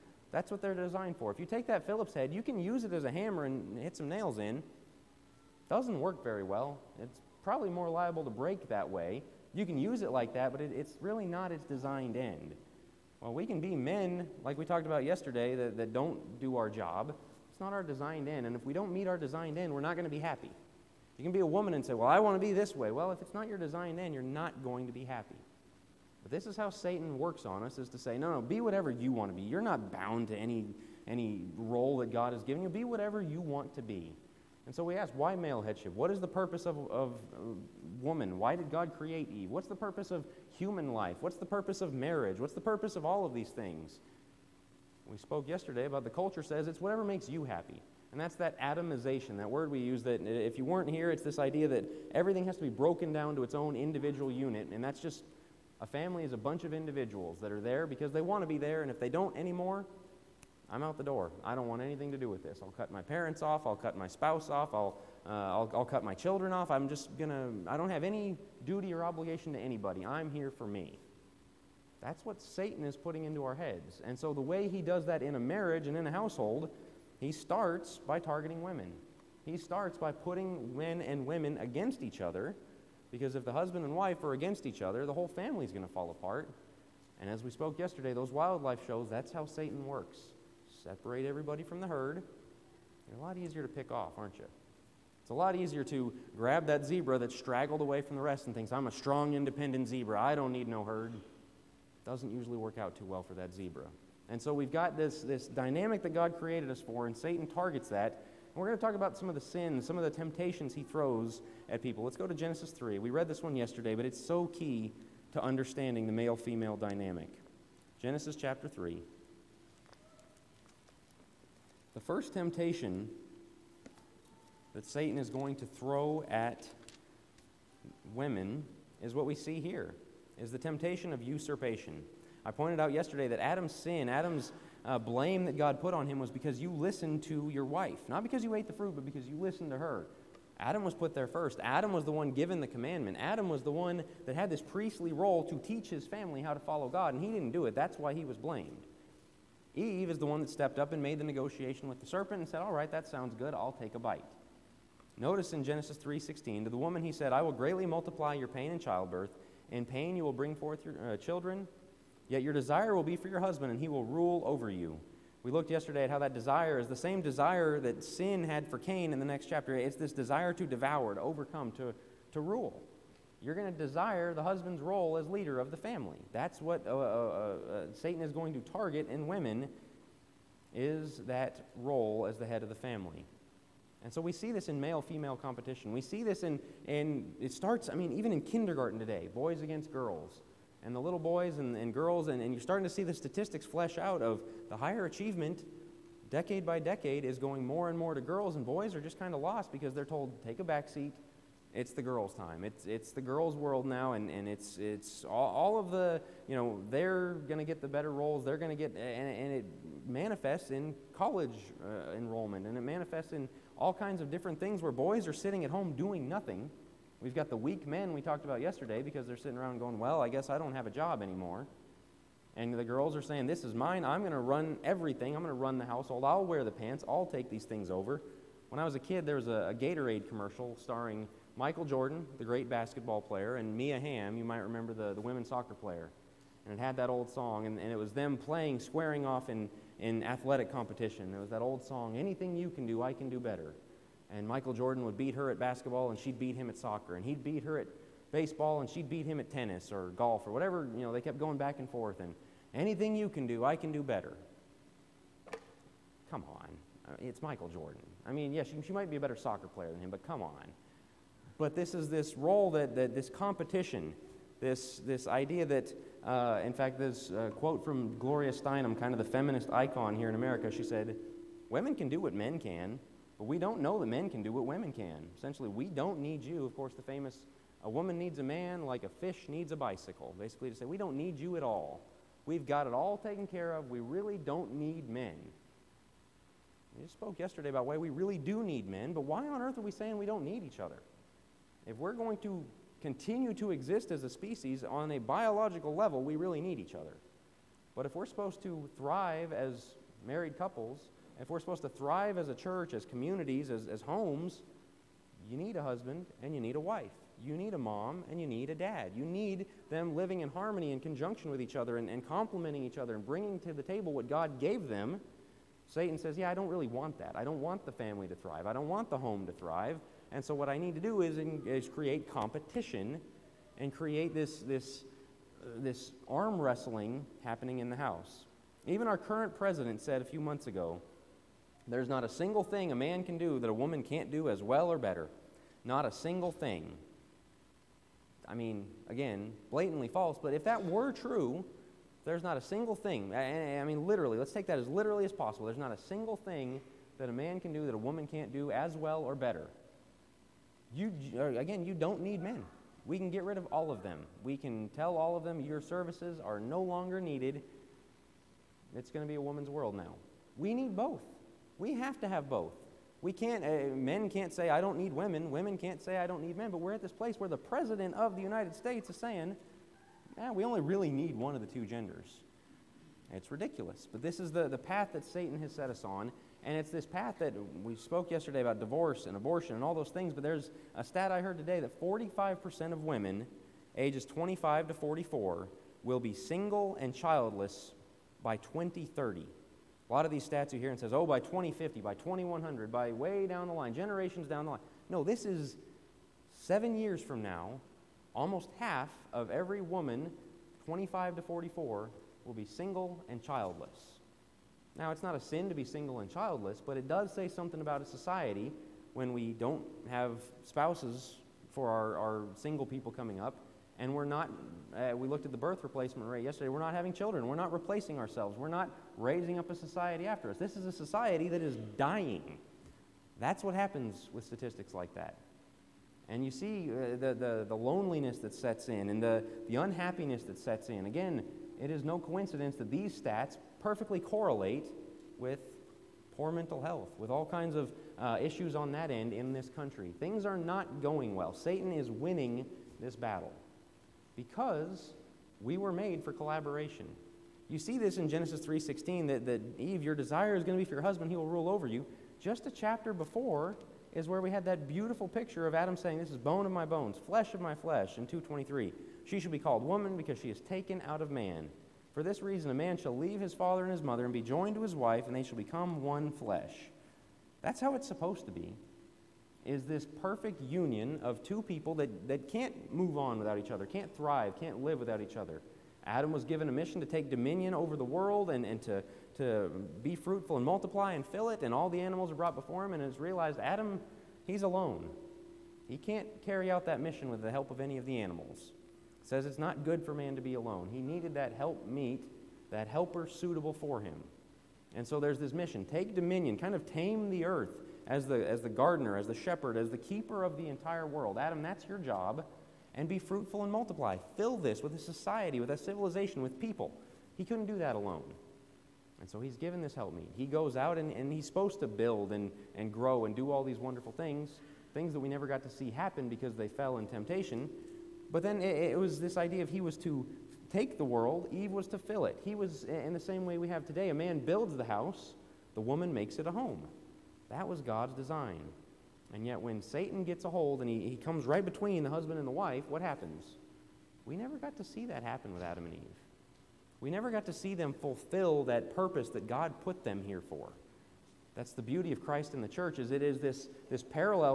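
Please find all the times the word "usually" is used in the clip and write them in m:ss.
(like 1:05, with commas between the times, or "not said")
1:42.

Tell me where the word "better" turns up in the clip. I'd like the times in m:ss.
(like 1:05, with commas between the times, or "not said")
3:27, 4:03, 4:14, 4:19, 5:34, 5:49.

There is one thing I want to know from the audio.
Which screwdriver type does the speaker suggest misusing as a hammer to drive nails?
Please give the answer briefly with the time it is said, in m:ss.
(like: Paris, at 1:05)
Phillips head, at 0:01.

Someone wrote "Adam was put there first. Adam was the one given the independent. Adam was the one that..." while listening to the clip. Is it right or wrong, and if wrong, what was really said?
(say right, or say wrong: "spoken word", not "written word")
wrong: "commandment", not "independent".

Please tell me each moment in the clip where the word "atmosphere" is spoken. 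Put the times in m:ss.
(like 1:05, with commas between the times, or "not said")
not said.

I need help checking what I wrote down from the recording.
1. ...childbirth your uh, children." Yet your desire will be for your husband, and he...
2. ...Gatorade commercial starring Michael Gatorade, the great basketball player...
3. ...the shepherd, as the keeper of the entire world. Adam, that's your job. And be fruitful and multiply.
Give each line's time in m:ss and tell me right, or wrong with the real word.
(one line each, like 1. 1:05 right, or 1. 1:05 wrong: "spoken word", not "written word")
1. 2:40 wrong: "forth", not "childbirth"
2. 3:49 wrong: "Jordan", not "Gatorade"
3. 8:19 right.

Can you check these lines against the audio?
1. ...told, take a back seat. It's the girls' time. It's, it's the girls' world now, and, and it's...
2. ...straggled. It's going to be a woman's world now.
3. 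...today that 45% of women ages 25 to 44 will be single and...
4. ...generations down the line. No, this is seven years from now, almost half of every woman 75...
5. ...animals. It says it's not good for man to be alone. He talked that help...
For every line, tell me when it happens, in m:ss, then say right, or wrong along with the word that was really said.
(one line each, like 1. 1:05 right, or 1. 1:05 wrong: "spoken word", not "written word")
1. 3:20 right
2. 5:57 wrong: "needed", not "straggled"
3. 6:21 right
4. 6:33 wrong: "25", not "75"
5. 8:08 wrong: "needed", not "talked".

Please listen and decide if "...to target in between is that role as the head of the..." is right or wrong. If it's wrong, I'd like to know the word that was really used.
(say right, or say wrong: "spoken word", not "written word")
wrong: "women", not "between".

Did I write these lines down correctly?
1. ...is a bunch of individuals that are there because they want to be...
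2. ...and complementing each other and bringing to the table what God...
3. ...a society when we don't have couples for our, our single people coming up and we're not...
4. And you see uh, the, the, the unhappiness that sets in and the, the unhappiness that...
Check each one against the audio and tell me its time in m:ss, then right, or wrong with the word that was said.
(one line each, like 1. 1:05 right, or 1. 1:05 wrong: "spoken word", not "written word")
1. 0:56 right
2. 5:12 right
3. 6:48 wrong: "spouses", not "couples"
4. 7:06 wrong: "loneliness", not "unhappiness".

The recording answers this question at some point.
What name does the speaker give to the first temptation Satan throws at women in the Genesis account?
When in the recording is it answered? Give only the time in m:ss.
2:11.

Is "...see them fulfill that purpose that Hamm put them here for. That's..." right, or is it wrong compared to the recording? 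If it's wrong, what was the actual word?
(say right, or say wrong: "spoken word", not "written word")
wrong: "God", not "Hamm".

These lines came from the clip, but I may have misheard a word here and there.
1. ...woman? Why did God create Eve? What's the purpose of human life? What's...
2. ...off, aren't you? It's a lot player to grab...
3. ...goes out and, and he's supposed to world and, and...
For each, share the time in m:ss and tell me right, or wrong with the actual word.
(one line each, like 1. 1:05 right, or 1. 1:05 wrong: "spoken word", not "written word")
1. 0:38 right
2. 1:33 wrong: "easier", not "player"
3. 8:30 wrong: "build", not "world".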